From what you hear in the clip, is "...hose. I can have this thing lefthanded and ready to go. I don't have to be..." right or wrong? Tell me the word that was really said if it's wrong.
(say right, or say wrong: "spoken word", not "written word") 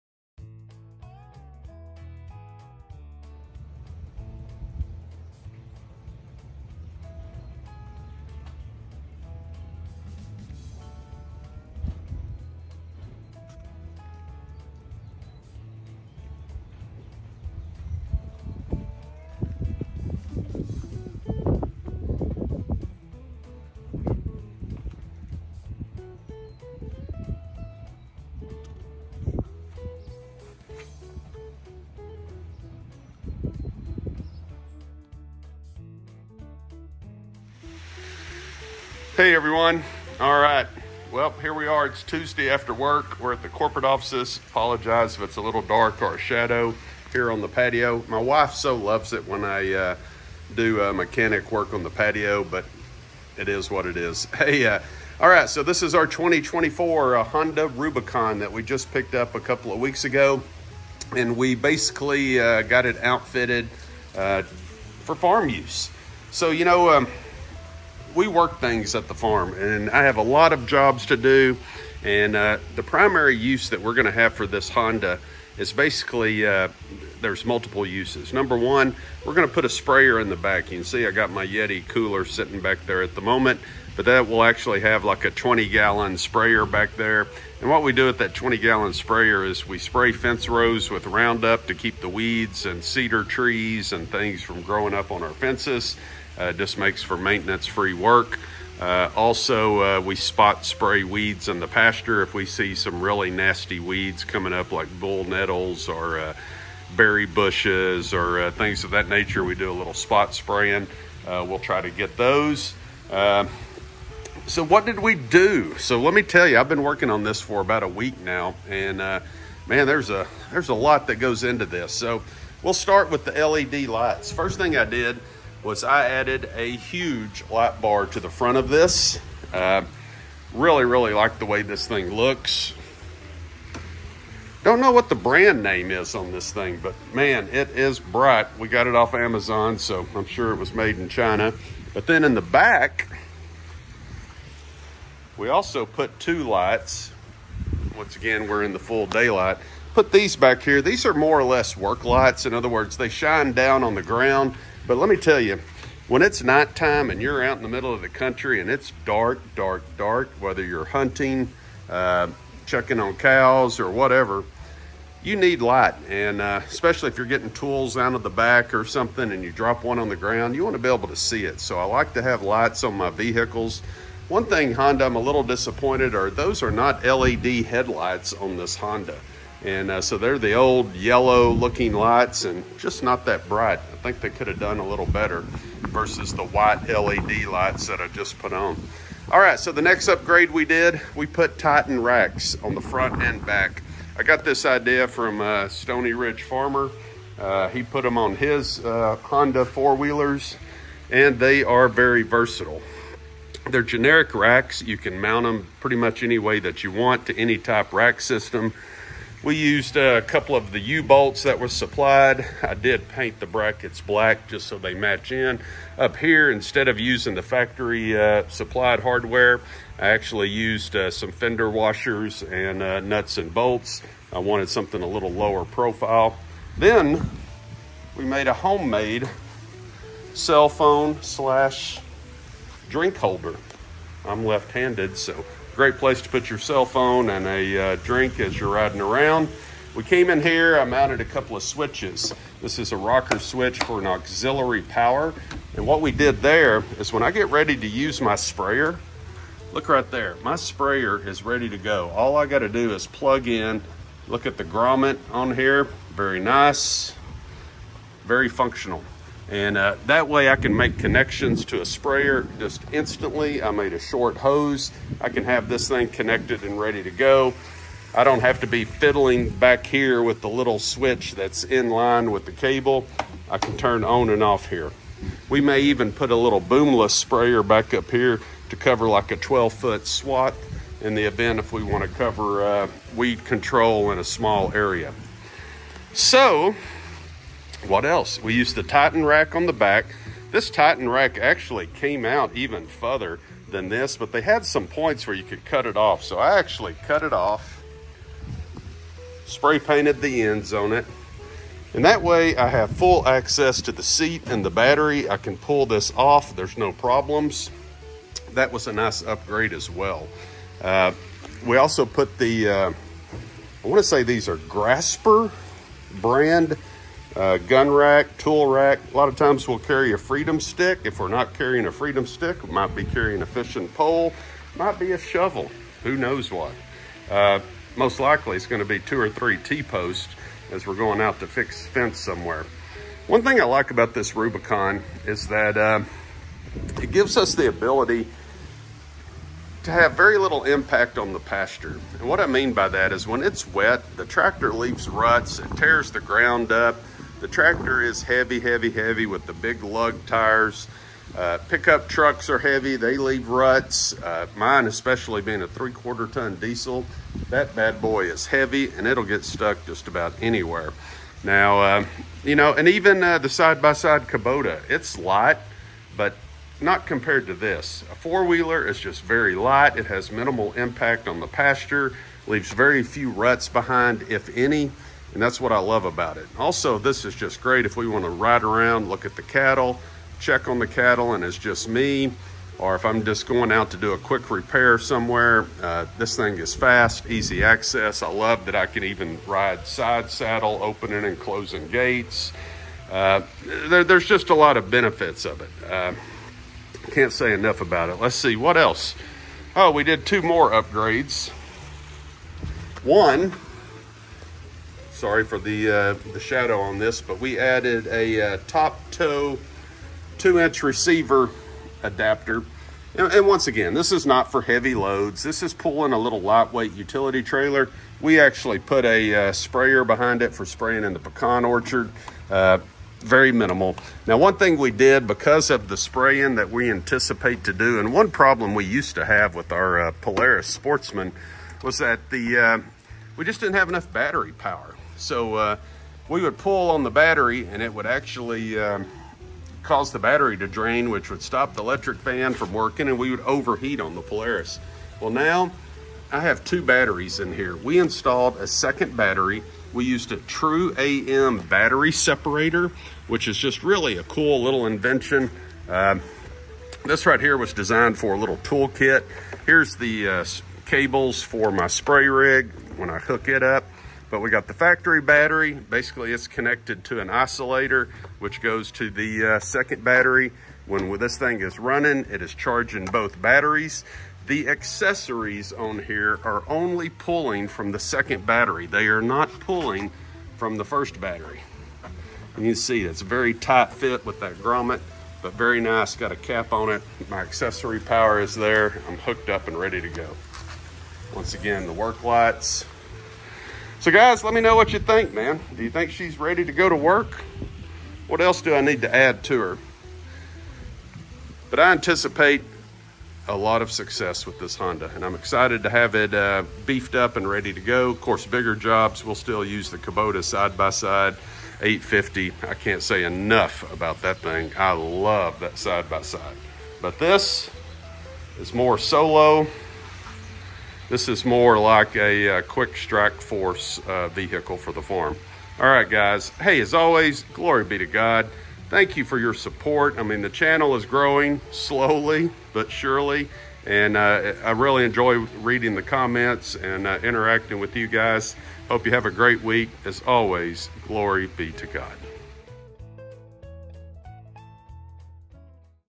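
wrong: "connected", not "lefthanded".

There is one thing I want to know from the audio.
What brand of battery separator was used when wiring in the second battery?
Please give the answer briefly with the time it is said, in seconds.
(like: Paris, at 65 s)
True AM, at 450 s.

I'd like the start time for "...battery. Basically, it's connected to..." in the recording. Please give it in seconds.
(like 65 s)
465 s.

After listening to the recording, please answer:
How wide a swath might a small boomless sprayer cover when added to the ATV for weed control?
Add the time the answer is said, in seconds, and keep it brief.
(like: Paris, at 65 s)
12 foot, at 279 s.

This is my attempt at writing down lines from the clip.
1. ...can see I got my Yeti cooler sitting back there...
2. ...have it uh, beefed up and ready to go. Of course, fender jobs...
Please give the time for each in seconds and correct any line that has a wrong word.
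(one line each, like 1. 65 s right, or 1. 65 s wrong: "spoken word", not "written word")
1. 80 s right
2. 505 s wrong: "bigger", not "fender".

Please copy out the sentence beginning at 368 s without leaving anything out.
A four-wheeler is just very light.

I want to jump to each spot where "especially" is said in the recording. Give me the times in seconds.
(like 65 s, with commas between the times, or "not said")
166 s, 354 s.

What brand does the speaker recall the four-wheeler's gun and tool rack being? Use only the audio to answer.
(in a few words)
Graspur.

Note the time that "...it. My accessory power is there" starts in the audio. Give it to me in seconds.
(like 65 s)
486 s.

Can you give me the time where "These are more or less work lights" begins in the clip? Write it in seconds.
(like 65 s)
150 s.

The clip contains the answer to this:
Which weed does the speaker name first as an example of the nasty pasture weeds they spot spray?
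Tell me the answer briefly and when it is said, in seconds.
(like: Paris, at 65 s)
bull nettles, at 104 s.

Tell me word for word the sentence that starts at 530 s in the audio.
I mean, the channel is growing slowly but surely.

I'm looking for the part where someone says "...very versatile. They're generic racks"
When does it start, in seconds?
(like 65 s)
201 s.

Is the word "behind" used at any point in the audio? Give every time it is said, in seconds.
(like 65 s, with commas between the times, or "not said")
373 s, 420 s.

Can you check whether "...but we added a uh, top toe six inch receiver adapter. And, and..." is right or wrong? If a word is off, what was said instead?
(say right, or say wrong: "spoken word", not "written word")
wrong: "two", not "six".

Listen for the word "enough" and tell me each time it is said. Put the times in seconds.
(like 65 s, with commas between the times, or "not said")
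397 s, 433 s, 513 s.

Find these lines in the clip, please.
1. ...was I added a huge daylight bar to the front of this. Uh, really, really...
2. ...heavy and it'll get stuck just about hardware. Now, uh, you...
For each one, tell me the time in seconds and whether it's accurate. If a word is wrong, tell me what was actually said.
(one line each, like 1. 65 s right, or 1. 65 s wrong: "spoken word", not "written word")
1. 125 s wrong: "light", not "daylight"
2. 358 s wrong: "anywhere", not "hardware".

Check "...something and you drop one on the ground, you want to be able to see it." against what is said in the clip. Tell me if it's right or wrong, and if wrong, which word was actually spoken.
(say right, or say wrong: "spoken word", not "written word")
right.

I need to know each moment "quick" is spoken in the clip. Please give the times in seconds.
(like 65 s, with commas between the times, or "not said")
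384 s, 522 s.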